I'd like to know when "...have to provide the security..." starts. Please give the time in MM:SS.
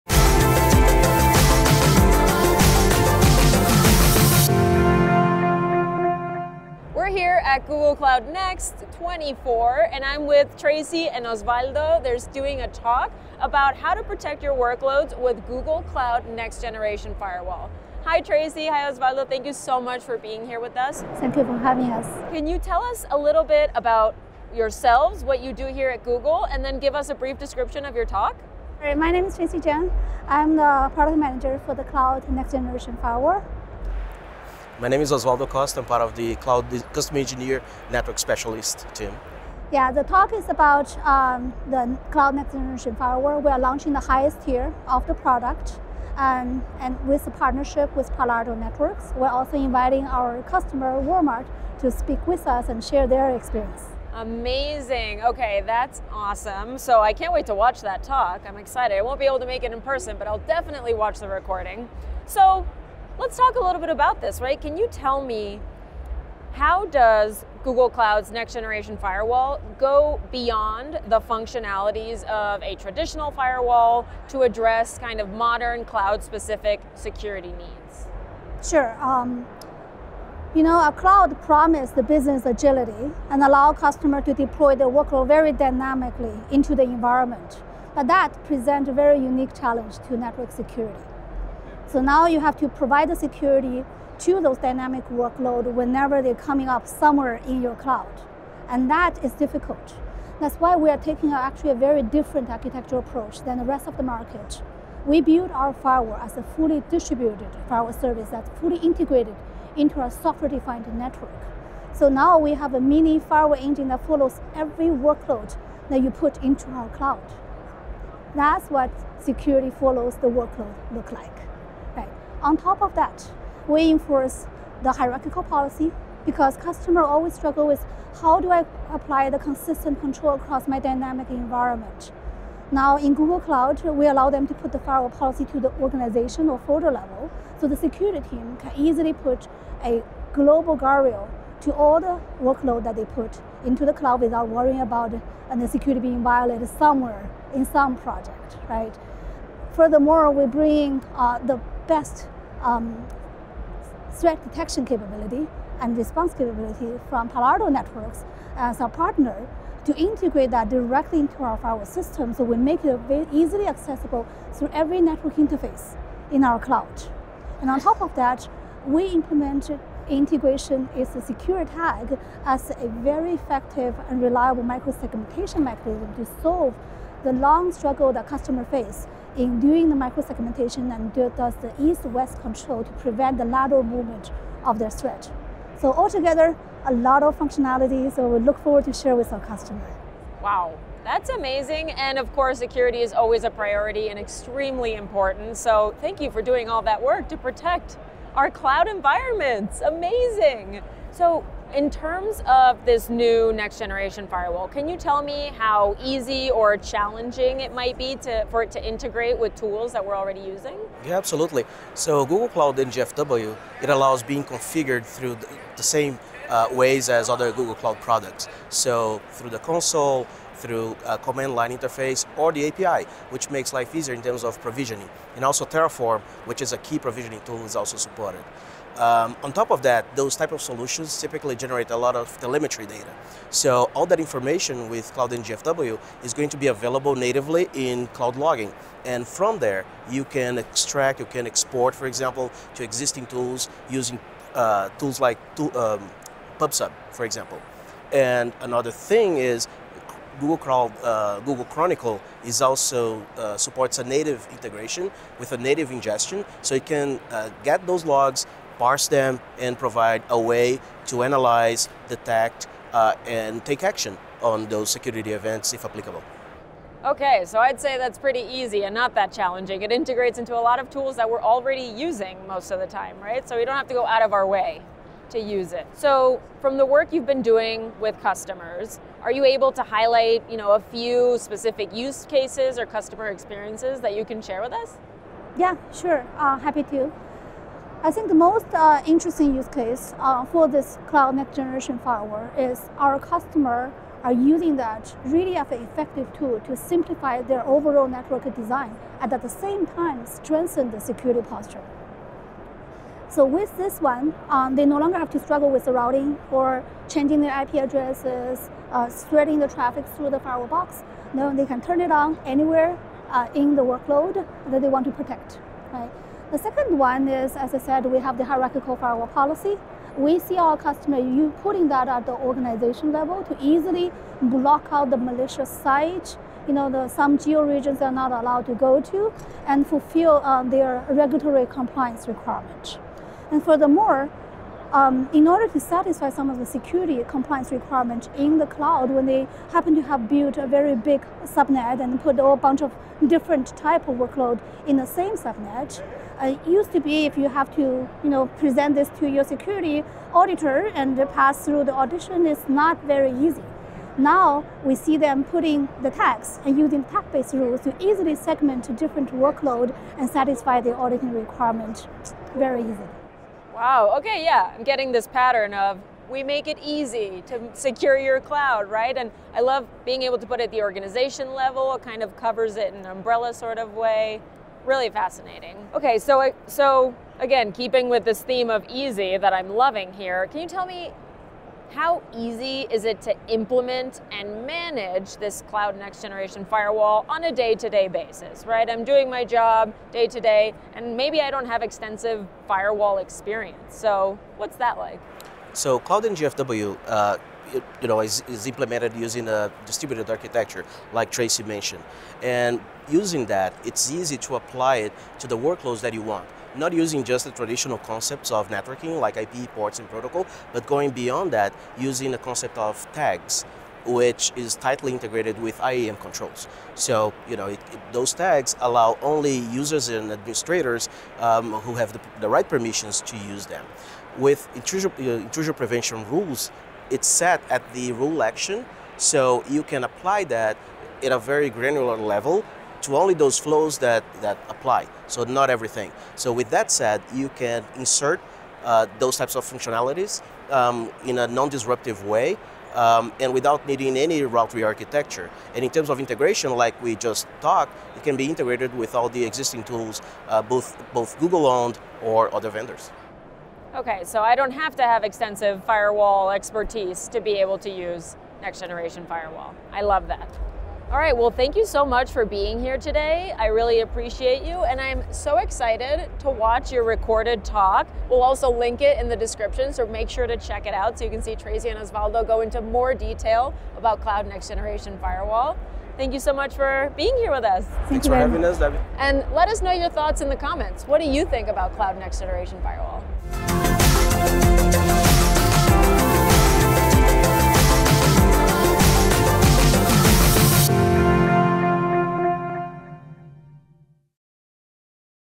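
01:32.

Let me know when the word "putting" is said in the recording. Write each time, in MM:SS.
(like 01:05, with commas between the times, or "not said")
05:21, 05:55.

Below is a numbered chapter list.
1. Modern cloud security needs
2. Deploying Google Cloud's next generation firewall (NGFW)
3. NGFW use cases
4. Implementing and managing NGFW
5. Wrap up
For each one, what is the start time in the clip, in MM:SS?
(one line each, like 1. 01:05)
1. 01:03
2. 03:21
3. 04:35
4. 06:21
5. 07:40.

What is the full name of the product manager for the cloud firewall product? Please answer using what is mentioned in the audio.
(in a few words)
Tracy Jiang.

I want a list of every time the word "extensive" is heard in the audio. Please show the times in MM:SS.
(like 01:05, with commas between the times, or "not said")
06:31, 07:35.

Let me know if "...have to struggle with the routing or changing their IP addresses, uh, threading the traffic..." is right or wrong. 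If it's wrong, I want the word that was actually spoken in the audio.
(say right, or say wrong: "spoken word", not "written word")
right.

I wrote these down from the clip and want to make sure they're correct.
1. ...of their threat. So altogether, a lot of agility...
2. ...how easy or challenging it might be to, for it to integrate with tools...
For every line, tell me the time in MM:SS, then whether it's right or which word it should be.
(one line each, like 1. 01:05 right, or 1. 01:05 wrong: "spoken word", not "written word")
1. 03:04 wrong: "functionality", not "agility"
2. 03:25 right.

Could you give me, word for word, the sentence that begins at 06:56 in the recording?
So, you know, it, it, those tags allow only users and administrators um, who have the, the, right permissions to use them.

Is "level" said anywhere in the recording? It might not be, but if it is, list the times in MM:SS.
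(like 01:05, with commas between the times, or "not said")
02:16, 05:23, 06:11, 07:12.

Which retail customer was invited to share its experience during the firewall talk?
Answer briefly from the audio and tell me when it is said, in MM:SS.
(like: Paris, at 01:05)
Walmart, at 00:51.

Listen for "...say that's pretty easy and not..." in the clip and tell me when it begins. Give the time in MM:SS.
04:27.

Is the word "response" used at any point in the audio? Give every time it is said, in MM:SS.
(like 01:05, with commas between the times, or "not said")
02:35.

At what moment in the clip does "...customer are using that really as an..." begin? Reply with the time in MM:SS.
04:53.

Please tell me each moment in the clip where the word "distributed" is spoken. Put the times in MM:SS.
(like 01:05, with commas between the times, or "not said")
01:46, 06:39.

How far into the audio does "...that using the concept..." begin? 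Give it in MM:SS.
06:51.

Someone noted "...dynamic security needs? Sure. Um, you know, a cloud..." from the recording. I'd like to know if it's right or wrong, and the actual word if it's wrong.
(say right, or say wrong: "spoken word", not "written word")
wrong: "specific", not "dynamic".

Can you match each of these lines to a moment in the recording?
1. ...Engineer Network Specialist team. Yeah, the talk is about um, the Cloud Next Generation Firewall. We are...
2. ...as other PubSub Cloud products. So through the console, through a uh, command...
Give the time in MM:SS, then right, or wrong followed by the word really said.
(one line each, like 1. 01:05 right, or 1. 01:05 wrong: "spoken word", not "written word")
1. 00:37 right
2. 03:37 wrong: "Google", not "PubSub".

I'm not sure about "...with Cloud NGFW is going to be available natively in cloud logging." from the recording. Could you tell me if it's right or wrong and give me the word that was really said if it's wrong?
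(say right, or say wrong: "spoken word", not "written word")
right.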